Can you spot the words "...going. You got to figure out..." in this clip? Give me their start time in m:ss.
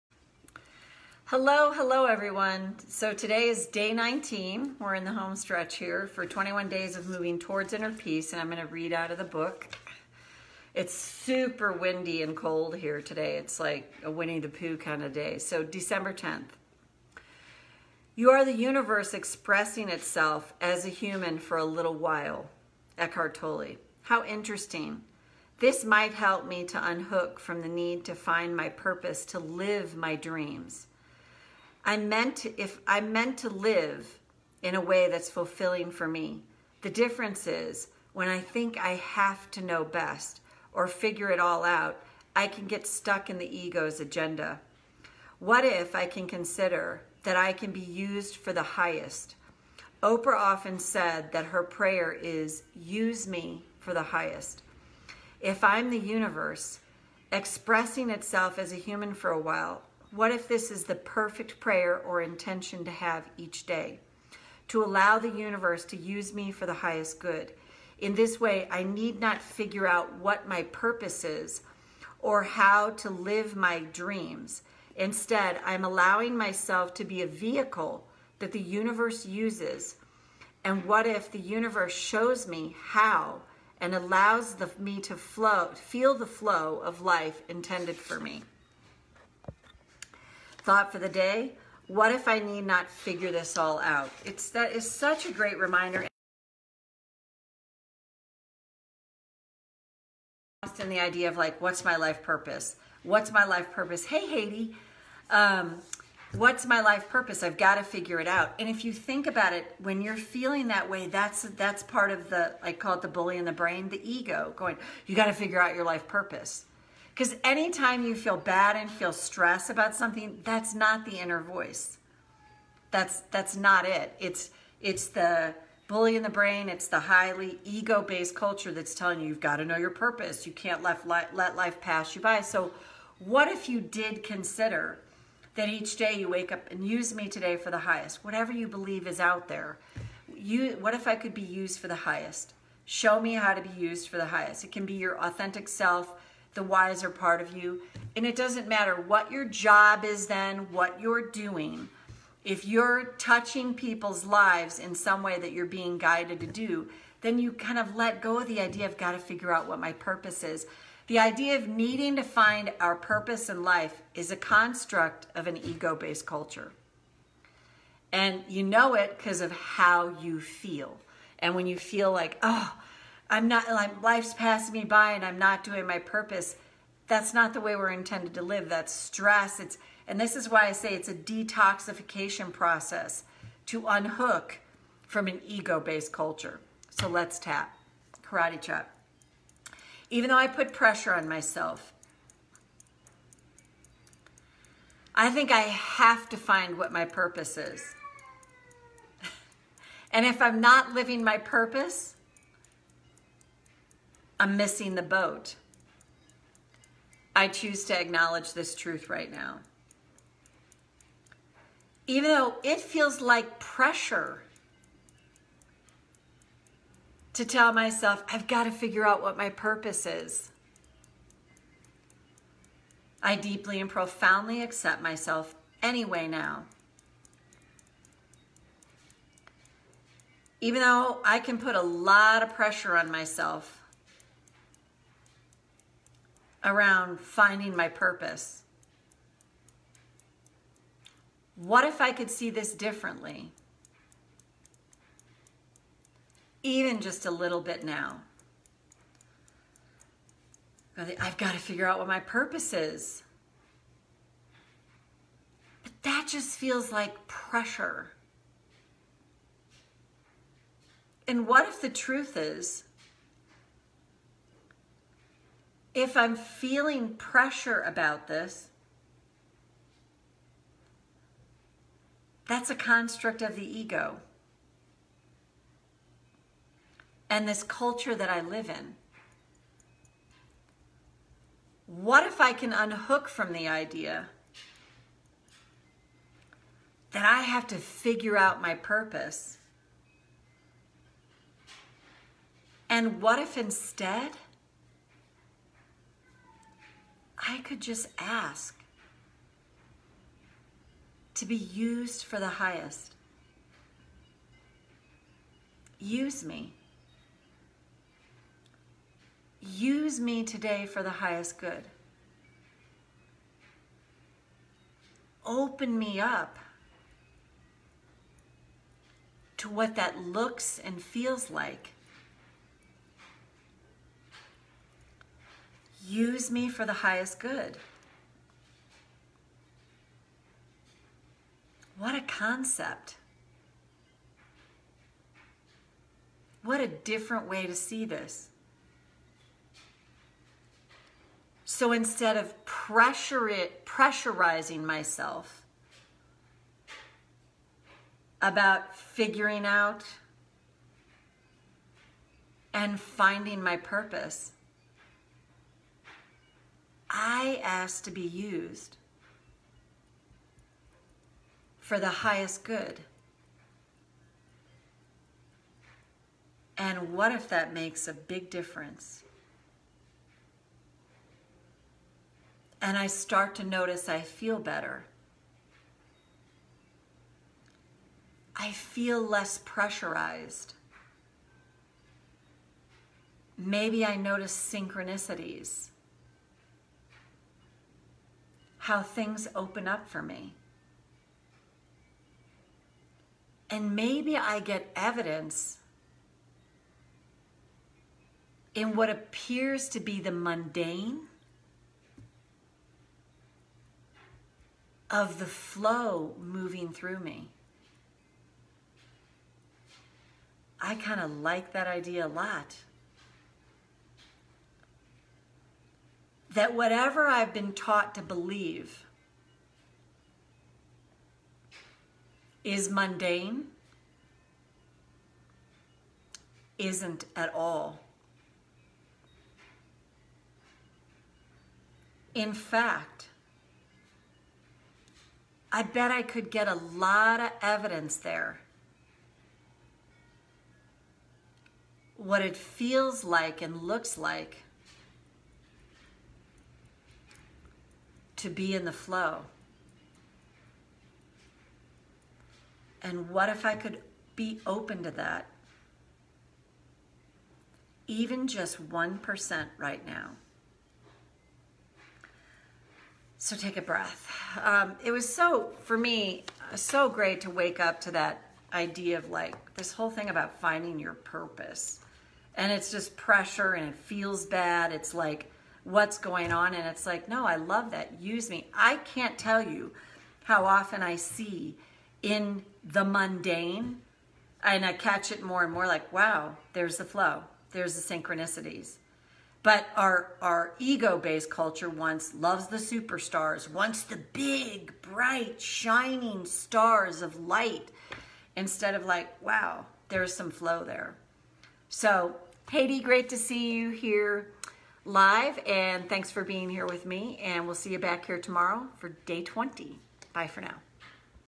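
1:54.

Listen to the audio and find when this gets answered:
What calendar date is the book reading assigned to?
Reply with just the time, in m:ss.
0:15.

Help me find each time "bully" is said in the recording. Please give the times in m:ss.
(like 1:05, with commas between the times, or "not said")
1:53, 2:05.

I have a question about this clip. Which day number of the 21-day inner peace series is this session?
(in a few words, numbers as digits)
19.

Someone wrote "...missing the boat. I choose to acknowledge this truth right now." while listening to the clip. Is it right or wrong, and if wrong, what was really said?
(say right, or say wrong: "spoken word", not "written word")
right.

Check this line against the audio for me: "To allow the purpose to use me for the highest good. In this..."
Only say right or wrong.
wrong.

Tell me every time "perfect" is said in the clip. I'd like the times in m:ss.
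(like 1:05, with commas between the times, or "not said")
1:00.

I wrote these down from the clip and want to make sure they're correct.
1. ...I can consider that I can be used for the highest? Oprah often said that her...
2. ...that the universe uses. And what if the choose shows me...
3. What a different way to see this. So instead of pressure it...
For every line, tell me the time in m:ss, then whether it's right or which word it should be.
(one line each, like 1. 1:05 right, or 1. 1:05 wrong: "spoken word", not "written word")
1. 0:45 right
2. 1:18 wrong: "universe", not "choose"
3. 5:36 right.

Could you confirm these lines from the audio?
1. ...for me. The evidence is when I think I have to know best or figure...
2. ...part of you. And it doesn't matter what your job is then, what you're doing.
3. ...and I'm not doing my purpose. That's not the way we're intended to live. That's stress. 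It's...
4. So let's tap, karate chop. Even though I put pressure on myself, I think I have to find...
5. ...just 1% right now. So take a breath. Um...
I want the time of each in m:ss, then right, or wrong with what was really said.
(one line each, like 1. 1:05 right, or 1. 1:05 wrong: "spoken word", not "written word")
1. 0:35 wrong: "difference", not "evidence"
2. 2:27 right
3. 2:55 right
4. 3:06 right
5. 7:38 right.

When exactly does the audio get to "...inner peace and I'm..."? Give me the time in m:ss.
0:07.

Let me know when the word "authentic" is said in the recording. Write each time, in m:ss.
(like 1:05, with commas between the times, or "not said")
2:25.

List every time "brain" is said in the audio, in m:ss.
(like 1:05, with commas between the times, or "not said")
1:53, 2:06.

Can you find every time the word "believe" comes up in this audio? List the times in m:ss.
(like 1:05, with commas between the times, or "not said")
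2:18, 6:58.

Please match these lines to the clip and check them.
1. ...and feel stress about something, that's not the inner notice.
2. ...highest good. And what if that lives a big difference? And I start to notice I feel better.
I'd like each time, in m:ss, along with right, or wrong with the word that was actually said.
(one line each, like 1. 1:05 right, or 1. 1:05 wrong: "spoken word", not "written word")
1. 1:58 wrong: "voice", not "notice"
2. 6:02 wrong: "makes", not "lives".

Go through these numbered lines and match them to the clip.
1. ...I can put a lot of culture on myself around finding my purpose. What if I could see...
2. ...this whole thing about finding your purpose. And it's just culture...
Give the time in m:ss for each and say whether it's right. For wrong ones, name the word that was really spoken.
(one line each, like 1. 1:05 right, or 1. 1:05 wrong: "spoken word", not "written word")
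1. 3:51 wrong: "pressure", not "culture"
2. 7:49 wrong: "pressure", not "culture".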